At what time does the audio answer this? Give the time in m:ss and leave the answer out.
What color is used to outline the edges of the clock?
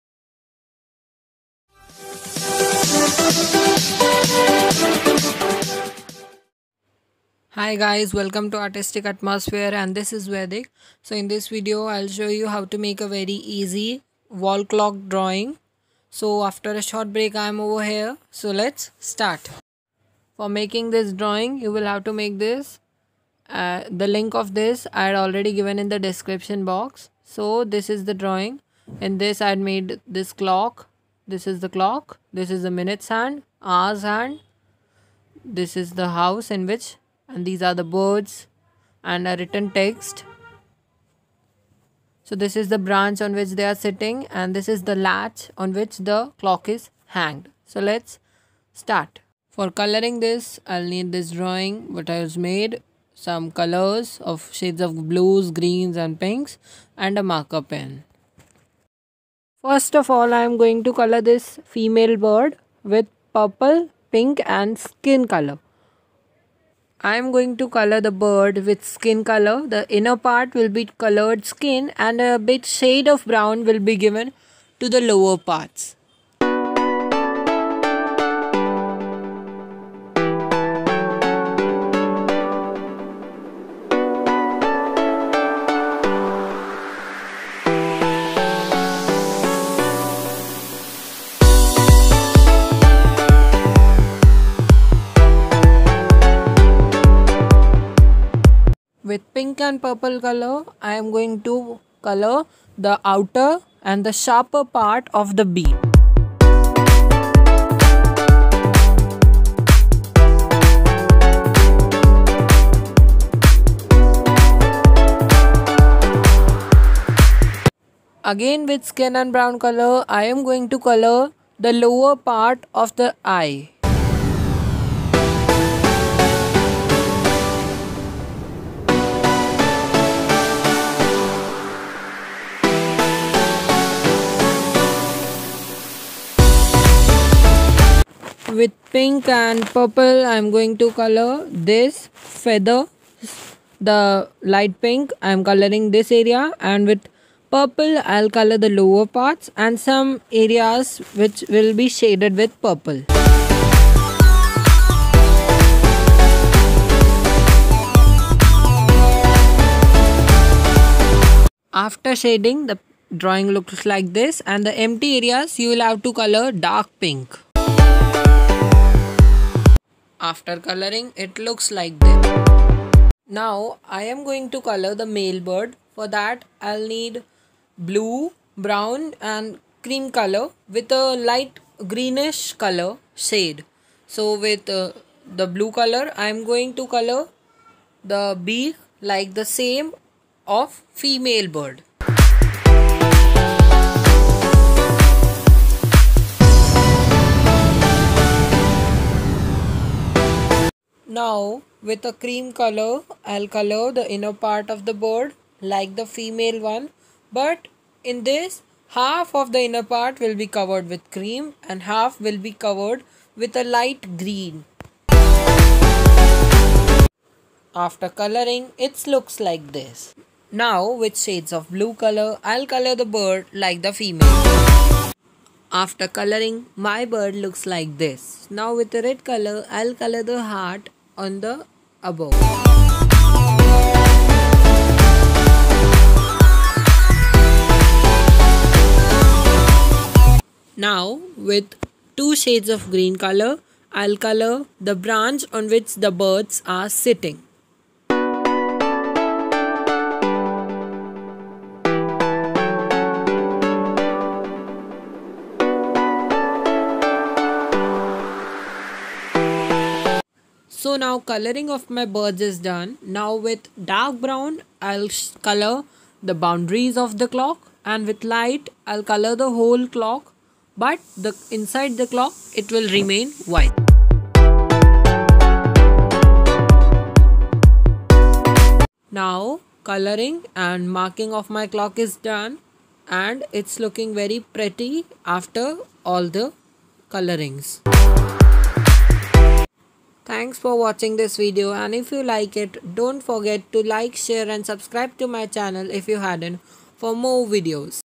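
4:23.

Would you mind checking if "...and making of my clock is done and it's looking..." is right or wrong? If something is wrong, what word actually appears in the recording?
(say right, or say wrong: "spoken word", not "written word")
wrong: "marking", not "making".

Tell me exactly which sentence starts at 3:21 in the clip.
Now with a cream color, I'll color the inner part of the bird like the female one.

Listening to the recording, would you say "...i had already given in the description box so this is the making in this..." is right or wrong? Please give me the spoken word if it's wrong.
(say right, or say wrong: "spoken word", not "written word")
wrong: "drawing", not "making".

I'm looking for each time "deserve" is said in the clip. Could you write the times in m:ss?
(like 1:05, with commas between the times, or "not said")
not said.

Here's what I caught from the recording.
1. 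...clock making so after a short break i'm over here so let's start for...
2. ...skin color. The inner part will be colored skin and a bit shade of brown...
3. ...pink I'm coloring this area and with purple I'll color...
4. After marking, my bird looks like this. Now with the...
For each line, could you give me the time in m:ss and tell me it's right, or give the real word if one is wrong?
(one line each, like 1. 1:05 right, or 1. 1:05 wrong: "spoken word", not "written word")
1. 0:14 wrong: "drawing", not "making"
2. 1:08 right
3. 2:24 right
4. 3:45 wrong: "coloring", not "marking".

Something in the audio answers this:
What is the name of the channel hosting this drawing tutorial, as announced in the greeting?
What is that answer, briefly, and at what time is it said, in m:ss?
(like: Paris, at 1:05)
Artistic Atmosphere, at 0:08.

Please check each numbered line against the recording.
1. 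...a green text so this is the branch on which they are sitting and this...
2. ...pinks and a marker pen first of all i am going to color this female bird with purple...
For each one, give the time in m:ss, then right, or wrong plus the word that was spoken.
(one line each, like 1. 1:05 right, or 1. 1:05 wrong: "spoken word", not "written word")
1. 0:39 wrong: "written", not "green"
2. 0:56 right.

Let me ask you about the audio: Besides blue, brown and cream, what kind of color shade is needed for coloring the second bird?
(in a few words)
light greenish.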